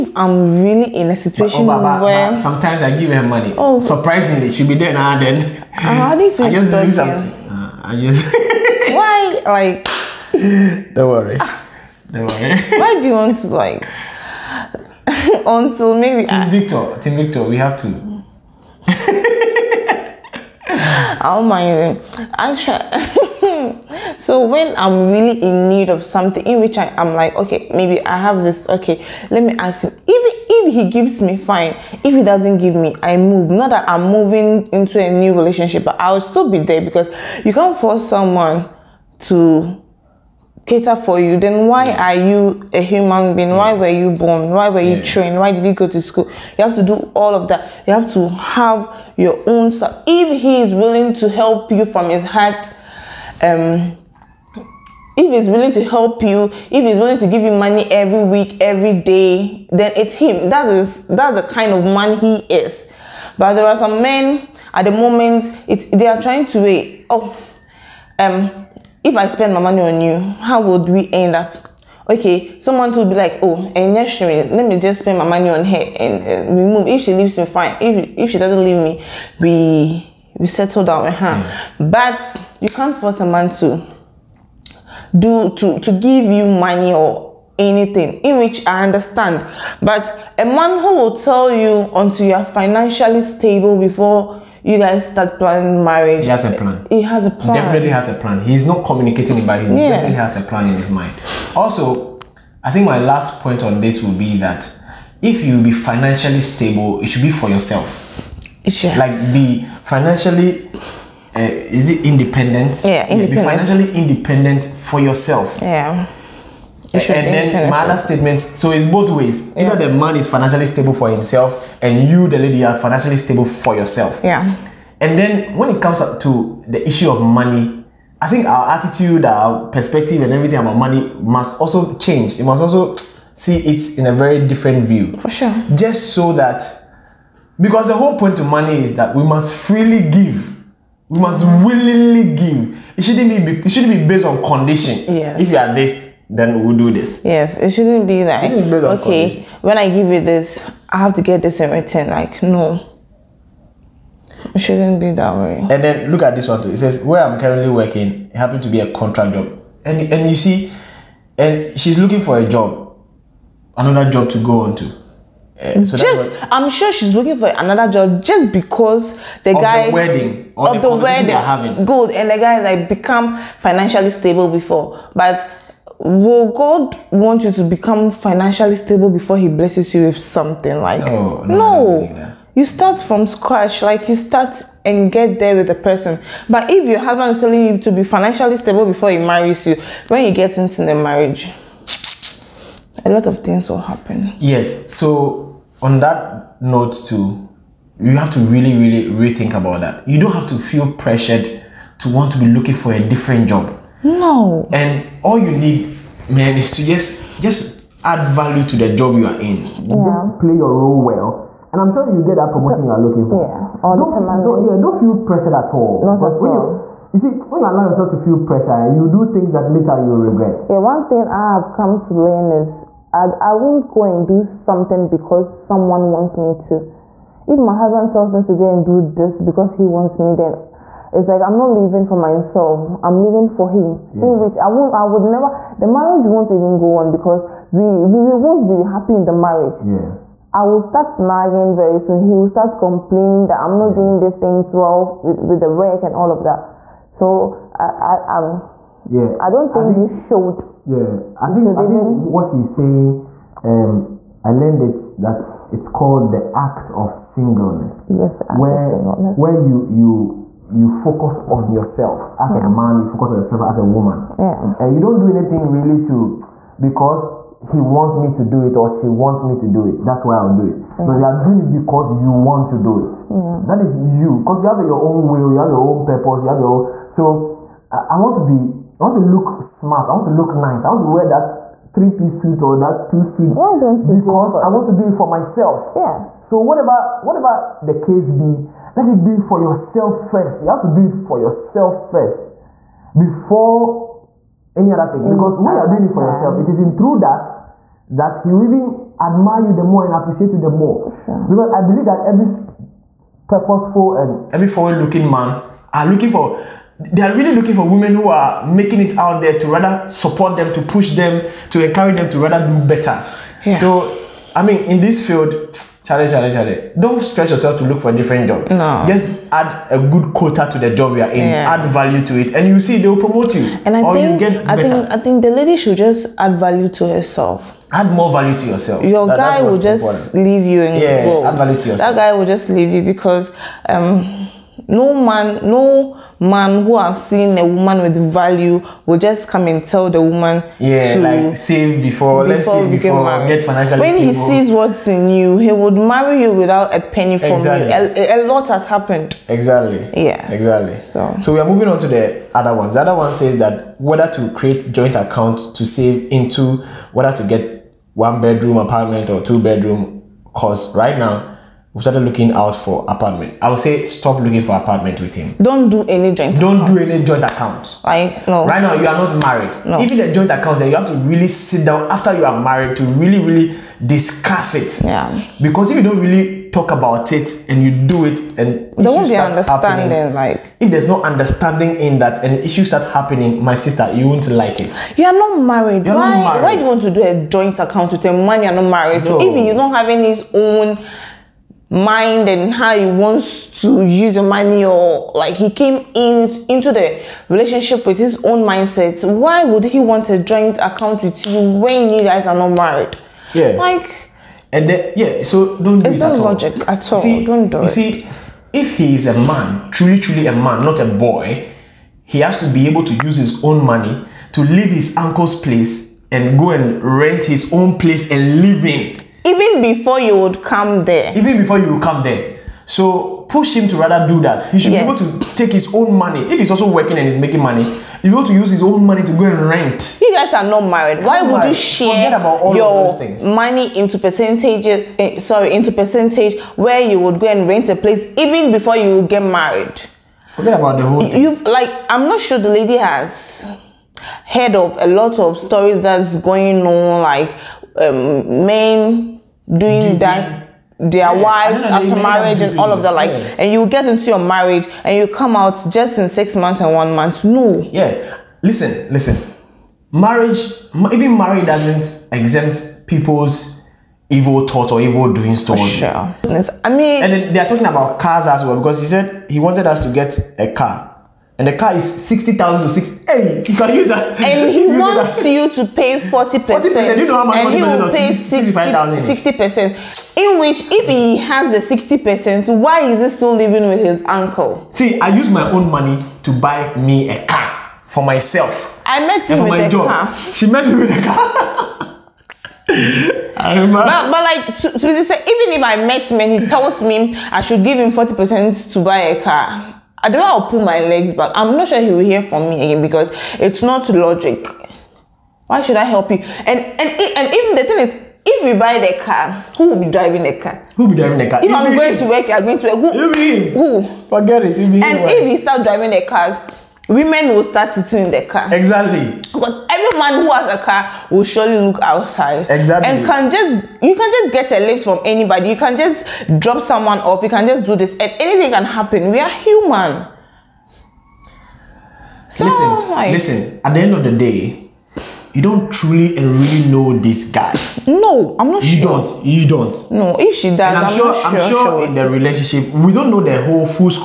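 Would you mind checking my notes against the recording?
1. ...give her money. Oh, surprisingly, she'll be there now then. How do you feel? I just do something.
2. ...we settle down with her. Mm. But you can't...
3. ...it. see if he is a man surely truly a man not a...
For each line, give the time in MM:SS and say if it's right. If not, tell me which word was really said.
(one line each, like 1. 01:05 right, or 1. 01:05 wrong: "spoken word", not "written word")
1. 00:02 right
2. 01:20 right
3. 06:47 wrong: "truly", not "surely".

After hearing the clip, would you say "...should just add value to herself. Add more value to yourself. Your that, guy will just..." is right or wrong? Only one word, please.
right.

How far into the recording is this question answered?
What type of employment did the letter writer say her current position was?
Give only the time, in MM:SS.
02:38.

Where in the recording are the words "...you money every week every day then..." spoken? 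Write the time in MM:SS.
00:57.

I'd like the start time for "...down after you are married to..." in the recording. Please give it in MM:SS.
06:11.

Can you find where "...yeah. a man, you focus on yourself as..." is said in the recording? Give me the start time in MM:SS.
04:22.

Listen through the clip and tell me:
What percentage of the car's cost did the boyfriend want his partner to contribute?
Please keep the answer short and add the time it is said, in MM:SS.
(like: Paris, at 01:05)
40%, at 07:56.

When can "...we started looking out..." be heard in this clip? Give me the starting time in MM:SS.
06:01.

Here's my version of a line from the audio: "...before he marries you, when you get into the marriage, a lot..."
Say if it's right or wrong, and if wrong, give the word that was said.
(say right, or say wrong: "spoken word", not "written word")
right.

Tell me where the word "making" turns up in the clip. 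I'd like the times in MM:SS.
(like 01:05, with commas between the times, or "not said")
05:08, 07:07.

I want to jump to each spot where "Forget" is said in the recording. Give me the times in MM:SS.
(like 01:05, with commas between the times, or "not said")
07:20, 08:34.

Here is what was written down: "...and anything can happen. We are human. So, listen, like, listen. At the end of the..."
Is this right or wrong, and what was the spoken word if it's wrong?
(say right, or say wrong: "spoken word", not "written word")
right.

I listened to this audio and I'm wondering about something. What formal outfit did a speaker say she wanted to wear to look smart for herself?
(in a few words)
three piece suit.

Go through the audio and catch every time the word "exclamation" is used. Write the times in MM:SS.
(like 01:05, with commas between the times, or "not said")
not said.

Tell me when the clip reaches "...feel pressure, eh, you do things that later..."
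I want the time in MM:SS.
03:38.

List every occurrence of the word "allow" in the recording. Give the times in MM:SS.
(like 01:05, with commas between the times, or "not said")
03:37.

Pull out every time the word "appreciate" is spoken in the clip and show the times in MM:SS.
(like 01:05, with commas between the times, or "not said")
05:00.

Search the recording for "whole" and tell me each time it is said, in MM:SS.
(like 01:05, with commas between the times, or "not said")
02:17, 07:21, 09:03.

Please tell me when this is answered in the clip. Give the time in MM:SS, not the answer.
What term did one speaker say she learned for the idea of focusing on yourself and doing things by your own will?
04:16.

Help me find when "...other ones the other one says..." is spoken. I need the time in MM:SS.
05:52.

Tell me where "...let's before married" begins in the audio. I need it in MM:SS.
05:42.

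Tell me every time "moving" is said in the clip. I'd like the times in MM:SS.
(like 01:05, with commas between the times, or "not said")
00:34, 05:51.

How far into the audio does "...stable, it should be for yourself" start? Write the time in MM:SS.
01:46.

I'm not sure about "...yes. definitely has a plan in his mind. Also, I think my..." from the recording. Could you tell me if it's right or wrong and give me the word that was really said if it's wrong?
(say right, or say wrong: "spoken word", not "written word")
right.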